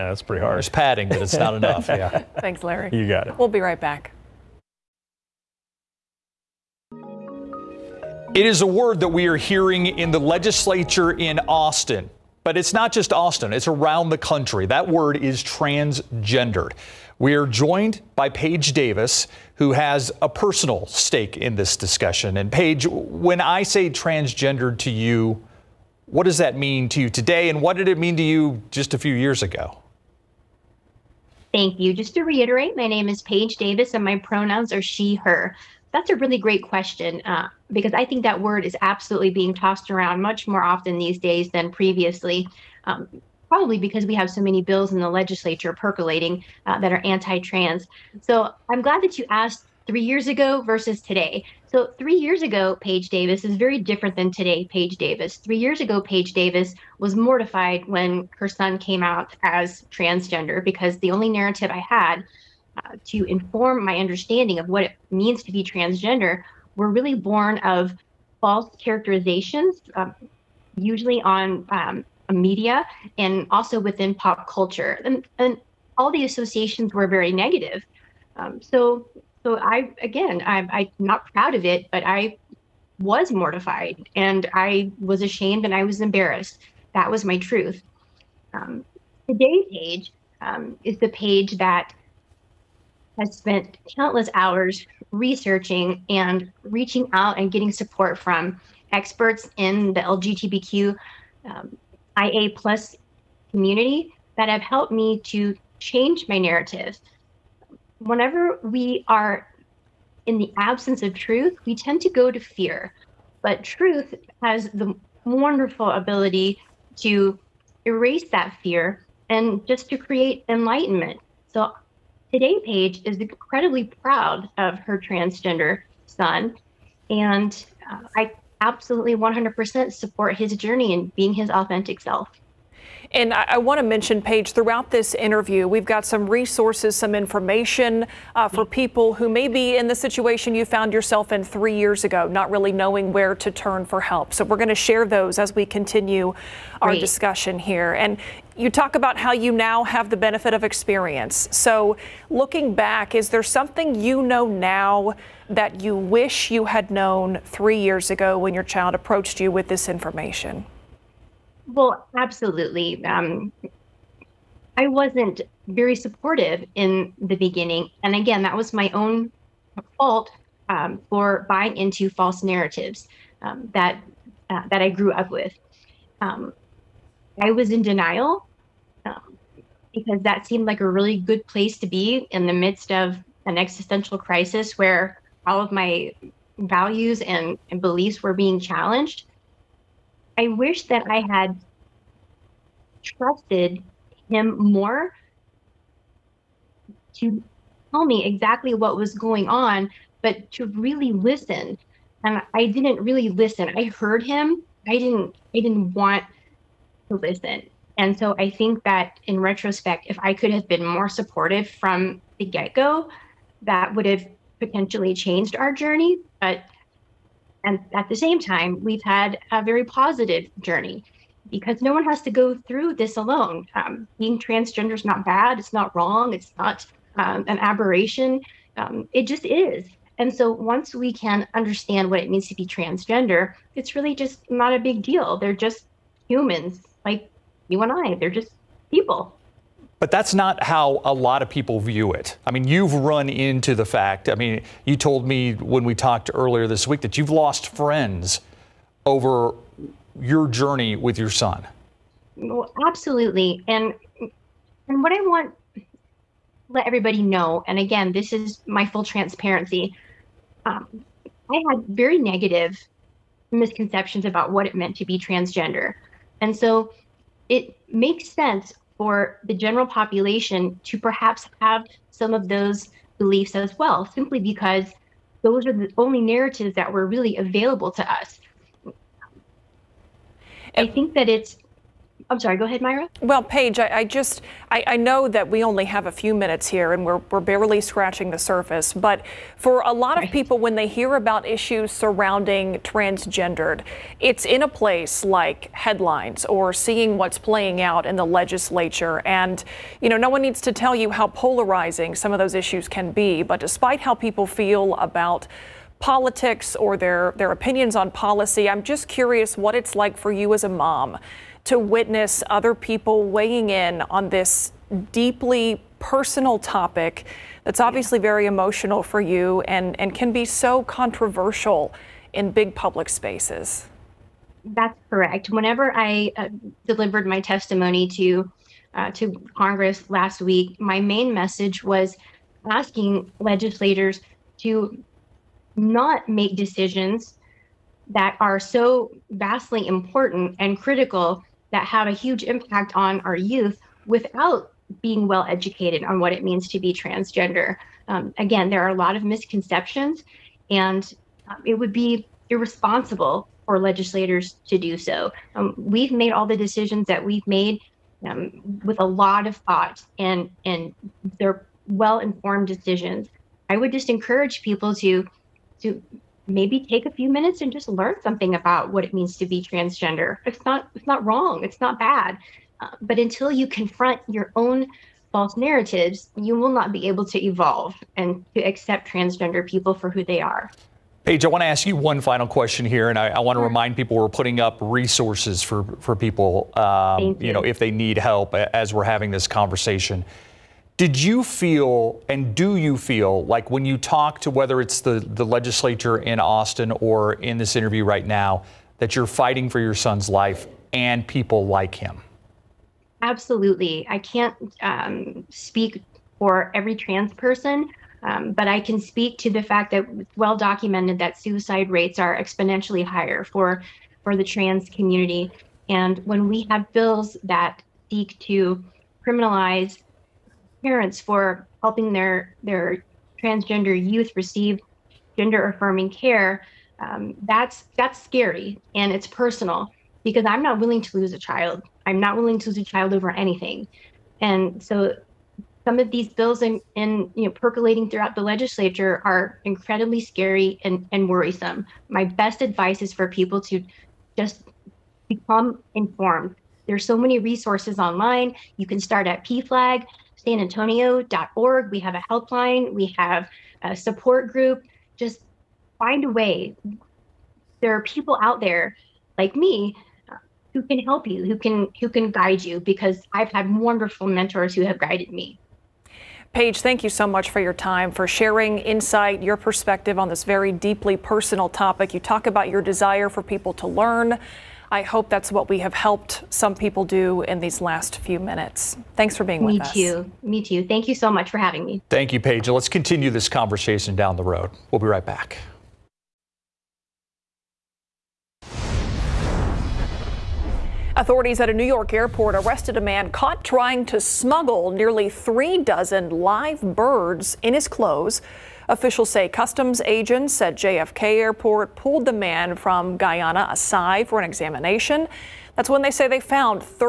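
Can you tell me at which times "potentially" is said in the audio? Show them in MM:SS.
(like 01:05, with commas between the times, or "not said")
03:34.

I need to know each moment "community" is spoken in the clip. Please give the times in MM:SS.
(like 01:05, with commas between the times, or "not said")
01:43, 06:54.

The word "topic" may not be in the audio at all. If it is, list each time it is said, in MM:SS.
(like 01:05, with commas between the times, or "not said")
05:16, 07:51.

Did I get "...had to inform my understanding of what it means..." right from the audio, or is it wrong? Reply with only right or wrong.
right.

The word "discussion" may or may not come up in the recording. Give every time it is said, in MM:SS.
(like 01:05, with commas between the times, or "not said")
00:21, 02:27.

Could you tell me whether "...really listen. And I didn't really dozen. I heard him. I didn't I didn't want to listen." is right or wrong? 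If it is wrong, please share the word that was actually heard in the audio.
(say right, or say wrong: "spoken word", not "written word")
wrong: "listen", not "dozen".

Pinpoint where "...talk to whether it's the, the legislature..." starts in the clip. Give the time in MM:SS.
06:33.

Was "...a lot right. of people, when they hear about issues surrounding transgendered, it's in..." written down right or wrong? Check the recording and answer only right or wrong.
right.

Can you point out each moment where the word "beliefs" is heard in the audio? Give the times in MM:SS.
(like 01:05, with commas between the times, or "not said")
03:07, 04:33.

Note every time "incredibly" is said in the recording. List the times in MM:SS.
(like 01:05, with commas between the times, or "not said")
02:03, 07:19.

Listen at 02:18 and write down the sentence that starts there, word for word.
people who may be in the situation you found yourself in three years ago, not really knowing where to turn for help.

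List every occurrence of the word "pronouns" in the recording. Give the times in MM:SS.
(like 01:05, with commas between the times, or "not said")
00:34.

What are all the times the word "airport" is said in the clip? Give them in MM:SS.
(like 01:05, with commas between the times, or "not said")
08:12, 08:21.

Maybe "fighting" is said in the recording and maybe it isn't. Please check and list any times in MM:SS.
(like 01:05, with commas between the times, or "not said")
06:39.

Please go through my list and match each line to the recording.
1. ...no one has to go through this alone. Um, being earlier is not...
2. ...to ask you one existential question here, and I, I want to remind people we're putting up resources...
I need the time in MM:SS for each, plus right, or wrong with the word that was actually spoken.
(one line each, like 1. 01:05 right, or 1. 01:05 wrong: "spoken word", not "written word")
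1. 03:41 wrong: "transgender", not "earlier"
2. 06:21 wrong: "final", not "existential".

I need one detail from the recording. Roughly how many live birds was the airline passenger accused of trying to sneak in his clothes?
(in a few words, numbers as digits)
nearly three dozen.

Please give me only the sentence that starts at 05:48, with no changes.
Um, again, there are a lot of misconceptions, and um, it would be irresponsible for legislators to do so.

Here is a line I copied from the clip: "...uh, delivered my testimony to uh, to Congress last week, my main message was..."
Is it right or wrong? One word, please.
right.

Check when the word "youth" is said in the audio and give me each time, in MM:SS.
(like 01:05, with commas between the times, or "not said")
05:43, 07:04.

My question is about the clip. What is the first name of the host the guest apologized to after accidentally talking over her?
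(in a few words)
Myra.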